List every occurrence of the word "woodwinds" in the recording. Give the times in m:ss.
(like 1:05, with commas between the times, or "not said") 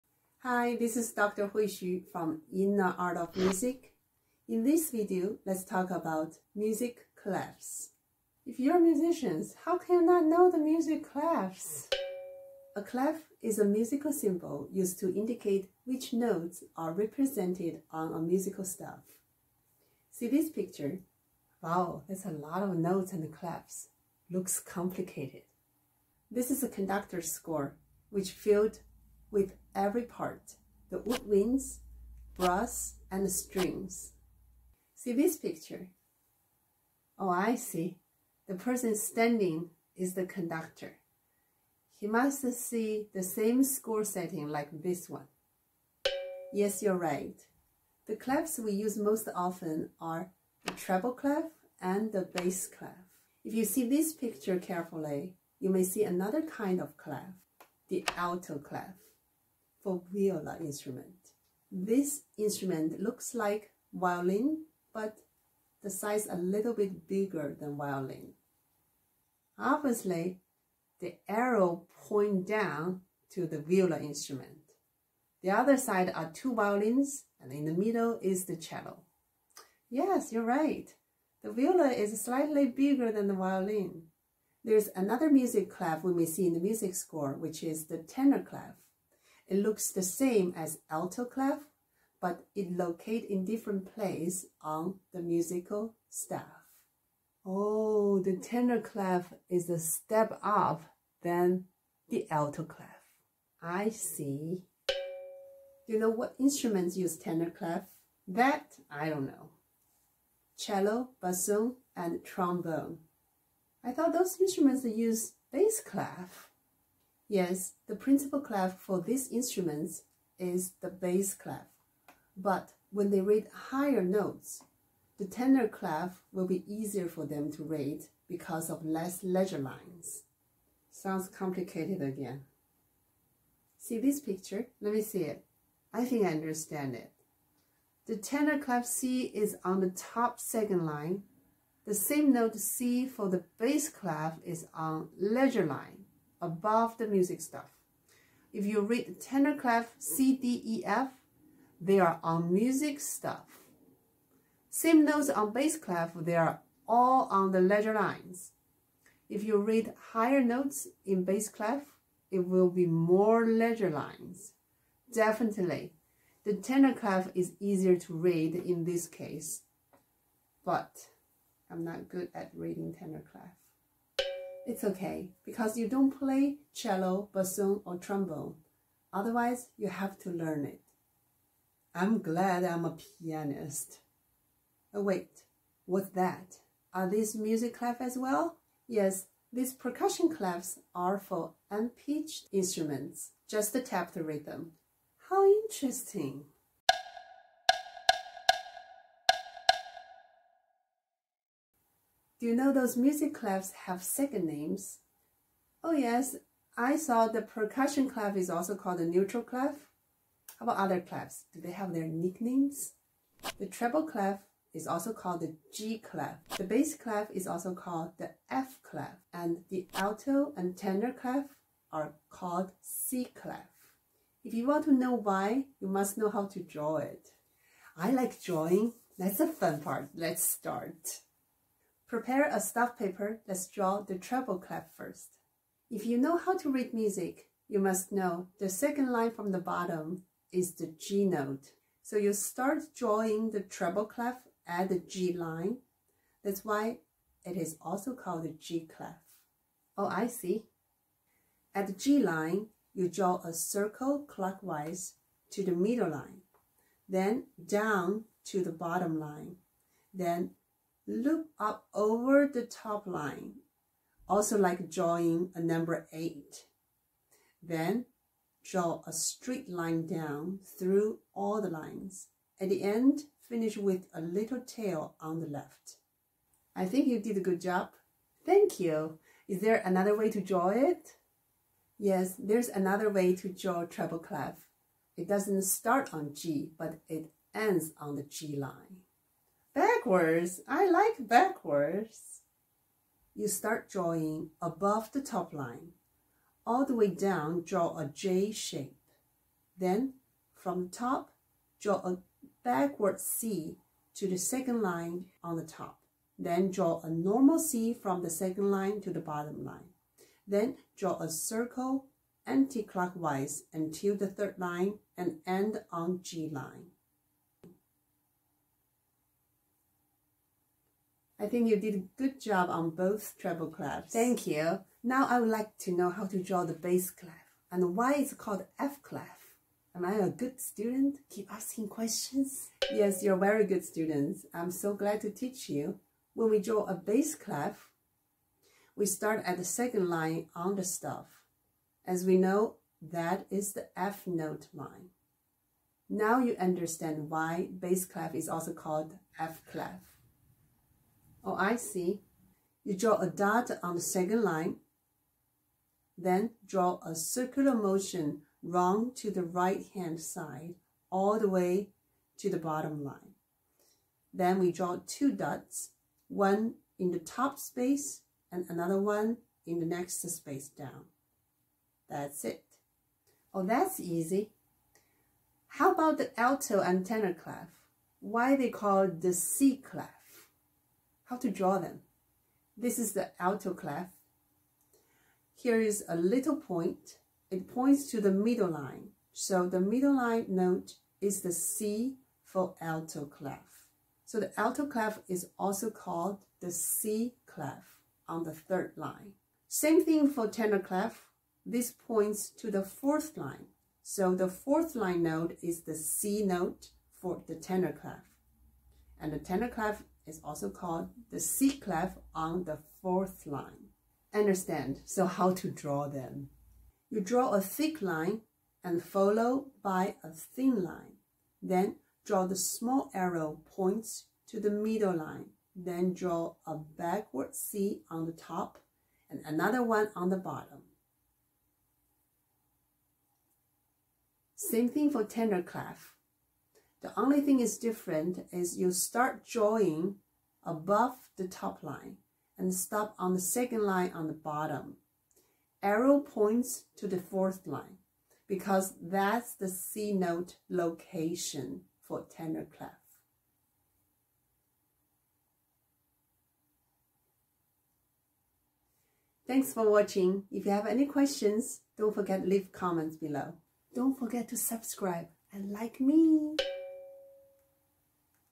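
0:30.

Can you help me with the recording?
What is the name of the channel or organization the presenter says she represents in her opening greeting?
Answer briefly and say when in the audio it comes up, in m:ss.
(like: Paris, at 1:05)
Inner Art of Music, at 0:02.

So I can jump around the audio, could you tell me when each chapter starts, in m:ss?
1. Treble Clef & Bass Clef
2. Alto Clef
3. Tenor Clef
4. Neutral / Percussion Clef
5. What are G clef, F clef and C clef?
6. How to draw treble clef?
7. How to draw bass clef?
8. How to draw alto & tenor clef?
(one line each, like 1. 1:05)
1. 0:20
2. 0:53
3. 1:24
4. 3:04
5. 3:33
6. 3:51
7. 5:36
8. 6:57.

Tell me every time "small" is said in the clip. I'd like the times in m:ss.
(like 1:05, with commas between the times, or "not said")
7:02.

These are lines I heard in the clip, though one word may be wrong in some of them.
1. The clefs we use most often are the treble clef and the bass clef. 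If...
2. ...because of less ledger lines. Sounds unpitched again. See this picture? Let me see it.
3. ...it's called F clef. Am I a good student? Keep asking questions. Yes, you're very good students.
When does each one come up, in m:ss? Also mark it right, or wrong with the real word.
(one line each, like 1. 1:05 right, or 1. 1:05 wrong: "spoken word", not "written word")
1. 0:48 right
2. 2:08 wrong: "complicated", not "unpitched"
3. 5:28 right.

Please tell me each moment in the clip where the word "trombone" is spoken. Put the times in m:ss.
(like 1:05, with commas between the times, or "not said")
1:52, 2:57.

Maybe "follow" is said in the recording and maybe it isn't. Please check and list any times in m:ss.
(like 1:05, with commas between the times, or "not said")
6:59.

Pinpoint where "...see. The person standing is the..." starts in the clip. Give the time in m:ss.
0:37.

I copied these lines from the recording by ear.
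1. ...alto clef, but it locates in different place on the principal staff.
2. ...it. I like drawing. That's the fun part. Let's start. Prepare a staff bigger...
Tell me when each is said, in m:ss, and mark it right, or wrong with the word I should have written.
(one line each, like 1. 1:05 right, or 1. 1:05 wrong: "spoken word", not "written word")
1. 1:30 wrong: "musical", not "principal"
2. 3:46 wrong: "paper", not "bigger".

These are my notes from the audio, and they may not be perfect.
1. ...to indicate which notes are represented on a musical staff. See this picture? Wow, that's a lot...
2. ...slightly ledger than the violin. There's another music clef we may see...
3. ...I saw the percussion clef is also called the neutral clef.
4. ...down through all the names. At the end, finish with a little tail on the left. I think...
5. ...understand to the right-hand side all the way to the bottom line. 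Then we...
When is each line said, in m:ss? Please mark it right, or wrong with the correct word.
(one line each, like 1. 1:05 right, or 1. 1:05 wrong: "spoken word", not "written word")
1. 0:15 right
2. 1:22 wrong: "bigger", not "ledger"
3. 3:26 right
4. 4:30 wrong: "lines", not "names"
5. 5:58 wrong: "round", not "understand".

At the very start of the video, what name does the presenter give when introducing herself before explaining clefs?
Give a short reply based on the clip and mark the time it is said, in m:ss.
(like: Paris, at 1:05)
Dr. Hui Xu, at 0:01.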